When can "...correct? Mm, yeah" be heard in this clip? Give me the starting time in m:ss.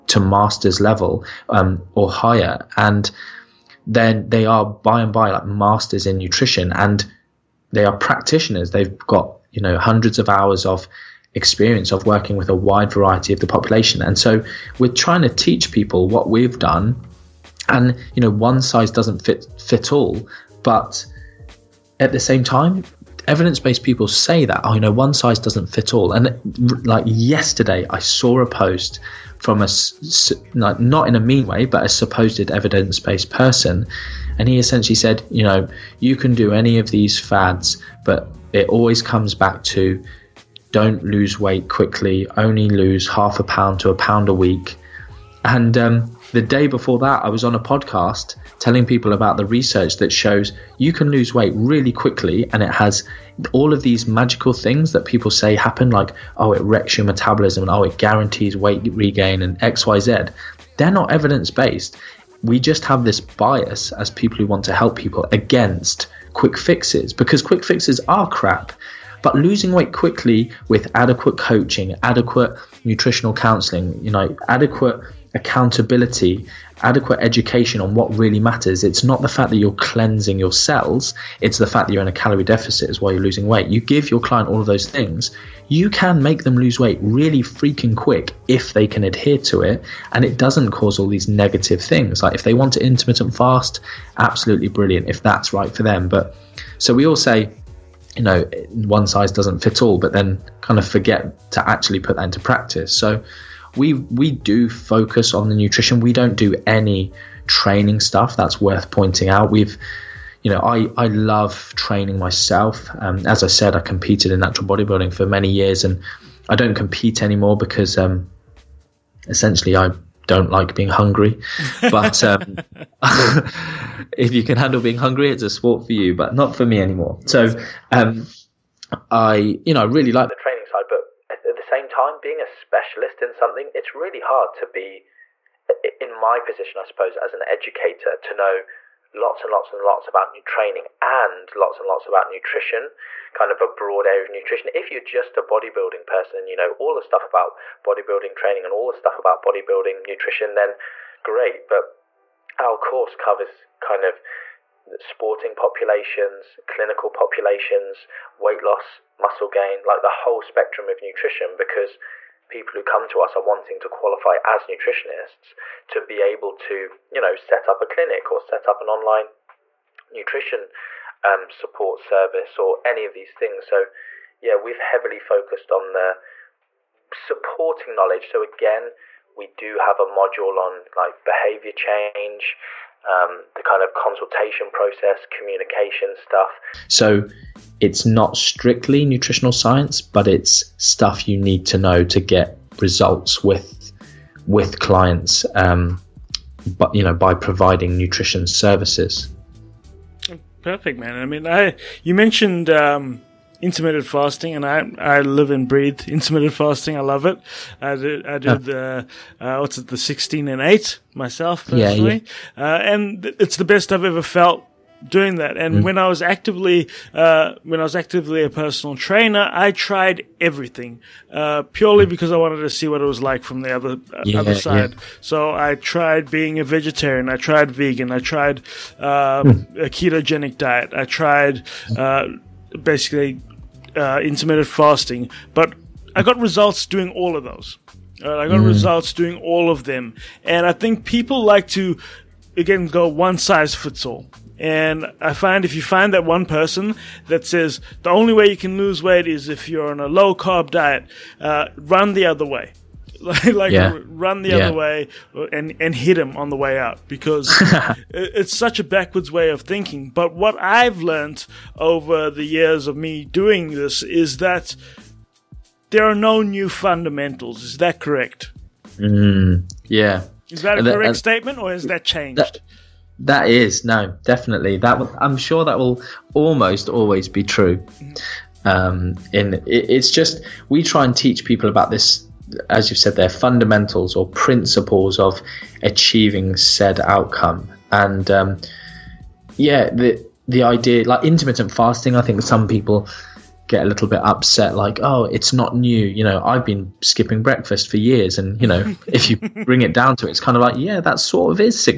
4:27.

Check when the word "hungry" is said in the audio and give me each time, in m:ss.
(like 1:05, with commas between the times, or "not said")
2:00, 2:04.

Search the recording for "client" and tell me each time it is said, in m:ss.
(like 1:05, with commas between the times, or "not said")
1:24, 3:14.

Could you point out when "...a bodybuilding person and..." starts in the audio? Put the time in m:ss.
2:25.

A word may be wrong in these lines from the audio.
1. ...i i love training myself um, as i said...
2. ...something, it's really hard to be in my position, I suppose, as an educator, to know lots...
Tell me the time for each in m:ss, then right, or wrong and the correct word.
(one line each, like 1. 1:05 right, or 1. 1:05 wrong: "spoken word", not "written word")
1. 1:50 right
2. 2:13 right.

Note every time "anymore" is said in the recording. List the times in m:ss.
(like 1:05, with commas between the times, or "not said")
1:57, 2:06.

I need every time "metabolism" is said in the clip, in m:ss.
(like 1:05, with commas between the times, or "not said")
0:57.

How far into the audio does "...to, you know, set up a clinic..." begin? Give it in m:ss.
2:46.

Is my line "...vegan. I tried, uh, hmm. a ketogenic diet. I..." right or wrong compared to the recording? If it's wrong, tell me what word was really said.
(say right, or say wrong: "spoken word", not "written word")
right.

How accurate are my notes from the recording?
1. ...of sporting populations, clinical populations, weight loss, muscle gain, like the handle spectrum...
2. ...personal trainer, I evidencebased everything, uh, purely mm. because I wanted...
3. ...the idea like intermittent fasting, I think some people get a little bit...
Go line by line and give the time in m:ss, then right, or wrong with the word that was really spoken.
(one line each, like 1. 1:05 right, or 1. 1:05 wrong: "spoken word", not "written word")
1. 2:34 wrong: "whole", not "handle"
2. 3:38 wrong: "tried", not "evidencebased"
3. 4:50 right.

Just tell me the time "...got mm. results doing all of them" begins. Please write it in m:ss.
3:58.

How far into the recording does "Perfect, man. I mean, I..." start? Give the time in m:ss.
3:20.